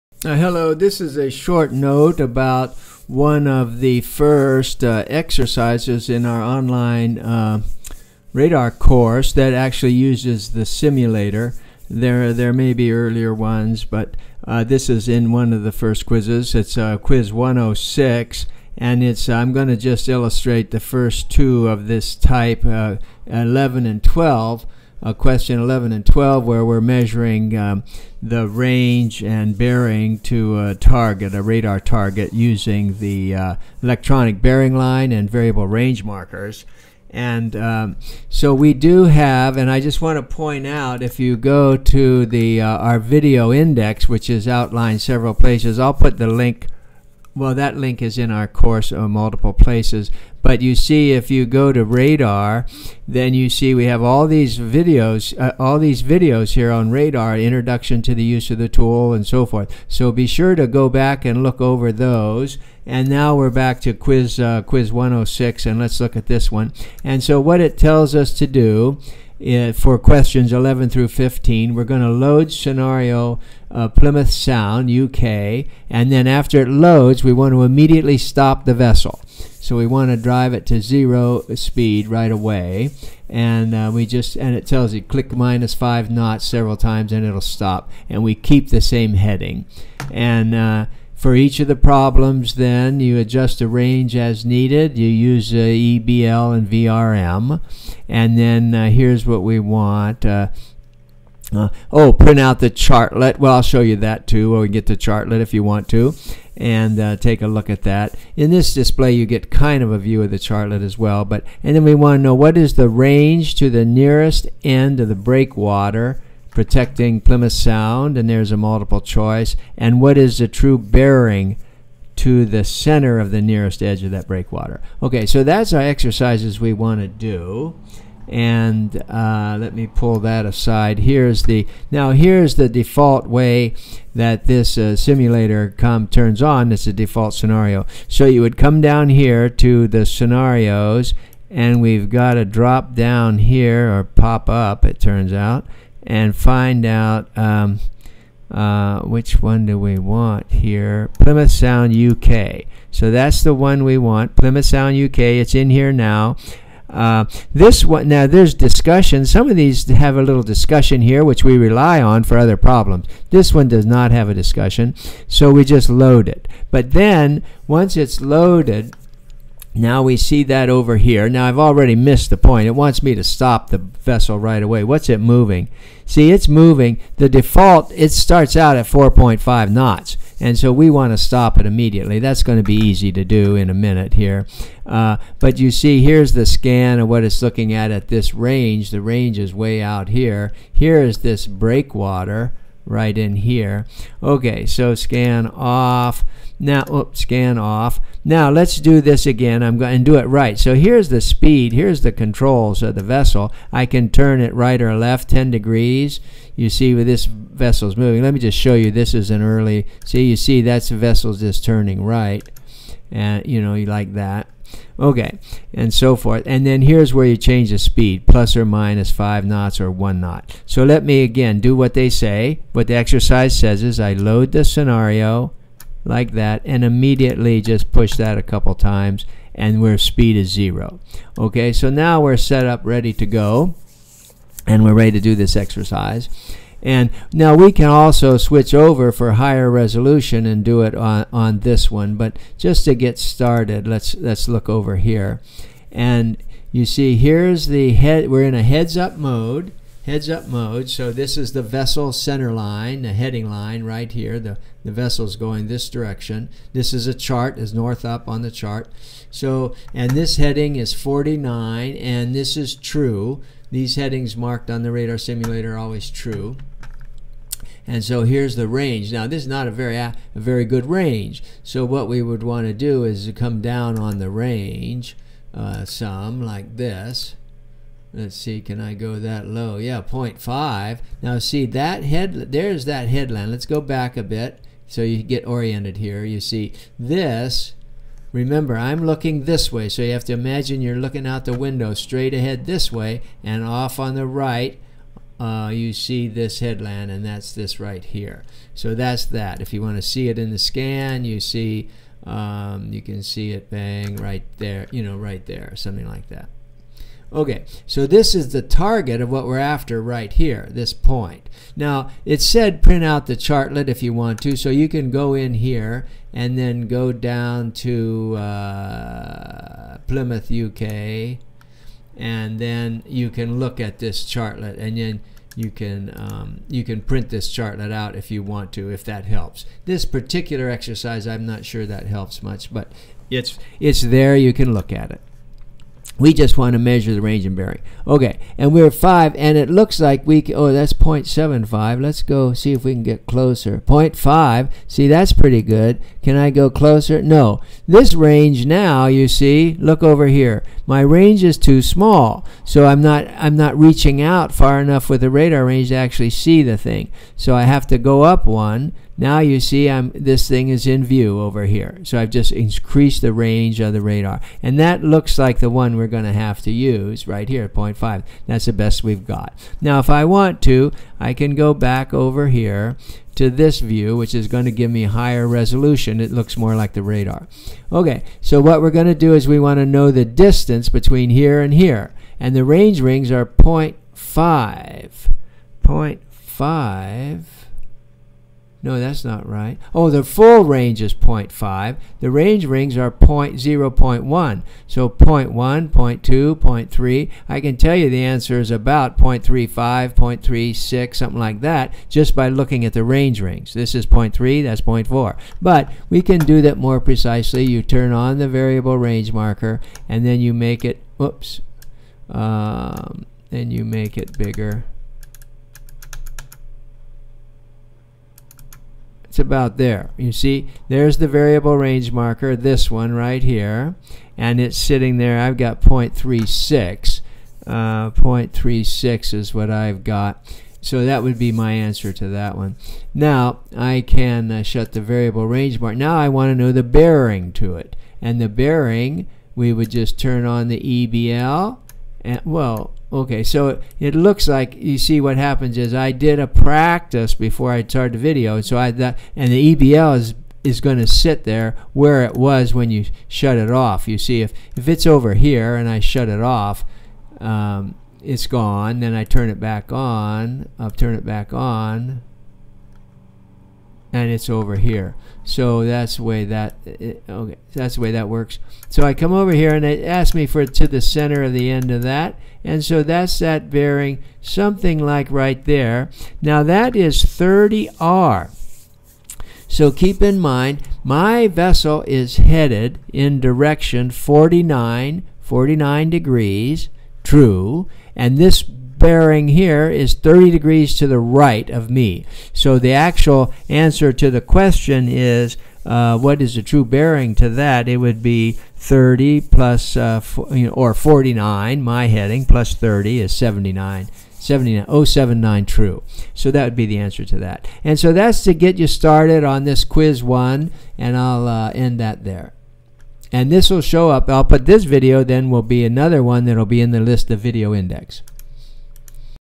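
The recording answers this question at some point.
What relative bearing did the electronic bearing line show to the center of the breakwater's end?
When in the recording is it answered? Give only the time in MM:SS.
07:57.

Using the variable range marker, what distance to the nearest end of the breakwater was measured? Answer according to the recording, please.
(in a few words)
0.36.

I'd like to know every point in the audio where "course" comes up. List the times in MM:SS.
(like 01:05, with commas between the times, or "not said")
00:08, 00:48.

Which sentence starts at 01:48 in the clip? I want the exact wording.
In this display, you get kind of a view of the chartlet as well.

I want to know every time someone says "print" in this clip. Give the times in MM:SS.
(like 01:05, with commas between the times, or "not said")
01:42, 05:12, 05:27.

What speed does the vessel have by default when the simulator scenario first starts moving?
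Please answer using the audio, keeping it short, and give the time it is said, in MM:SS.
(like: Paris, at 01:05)
4.5 knots, at 02:58.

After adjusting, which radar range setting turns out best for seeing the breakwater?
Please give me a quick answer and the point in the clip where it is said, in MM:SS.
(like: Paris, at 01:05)
0.5, at 06:07.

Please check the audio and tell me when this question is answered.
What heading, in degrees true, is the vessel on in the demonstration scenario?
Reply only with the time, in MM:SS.
04:20.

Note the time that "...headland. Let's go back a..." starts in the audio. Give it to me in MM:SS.
04:43.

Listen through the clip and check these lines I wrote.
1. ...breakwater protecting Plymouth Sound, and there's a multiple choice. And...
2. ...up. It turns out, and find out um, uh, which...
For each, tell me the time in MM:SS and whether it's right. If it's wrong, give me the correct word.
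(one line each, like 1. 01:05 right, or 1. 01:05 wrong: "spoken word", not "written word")
1. 01:55 right
2. 02:24 right.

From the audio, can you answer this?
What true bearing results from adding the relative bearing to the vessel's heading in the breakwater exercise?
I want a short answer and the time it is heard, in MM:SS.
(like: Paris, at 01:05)
079, at 08:25.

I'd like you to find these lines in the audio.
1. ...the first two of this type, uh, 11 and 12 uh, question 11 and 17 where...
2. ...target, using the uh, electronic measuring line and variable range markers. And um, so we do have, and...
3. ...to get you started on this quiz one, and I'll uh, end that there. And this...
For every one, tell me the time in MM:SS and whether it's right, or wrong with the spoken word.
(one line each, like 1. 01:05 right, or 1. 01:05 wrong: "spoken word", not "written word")
1. 00:20 wrong: "12", not "17"
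2. 00:31 wrong: "bearing", not "measuring"
3. 08:28 right.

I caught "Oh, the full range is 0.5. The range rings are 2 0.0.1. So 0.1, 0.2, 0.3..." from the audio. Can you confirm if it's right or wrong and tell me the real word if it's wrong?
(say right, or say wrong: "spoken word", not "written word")
wrong: "0", not "2".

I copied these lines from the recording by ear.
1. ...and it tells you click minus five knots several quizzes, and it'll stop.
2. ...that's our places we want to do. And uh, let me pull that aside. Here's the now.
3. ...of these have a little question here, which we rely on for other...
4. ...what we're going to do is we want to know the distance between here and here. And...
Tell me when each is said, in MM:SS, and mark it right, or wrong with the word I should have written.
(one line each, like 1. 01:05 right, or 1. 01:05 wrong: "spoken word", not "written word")
1. 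01:24 wrong: "times", not "quizzes"
2. 02:05 wrong: "exercises", not "places"
3. 02:39 wrong: "discussion", not "question"
4. 06:18 right.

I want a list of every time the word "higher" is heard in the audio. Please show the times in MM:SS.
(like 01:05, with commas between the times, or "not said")
03:59, 06:15.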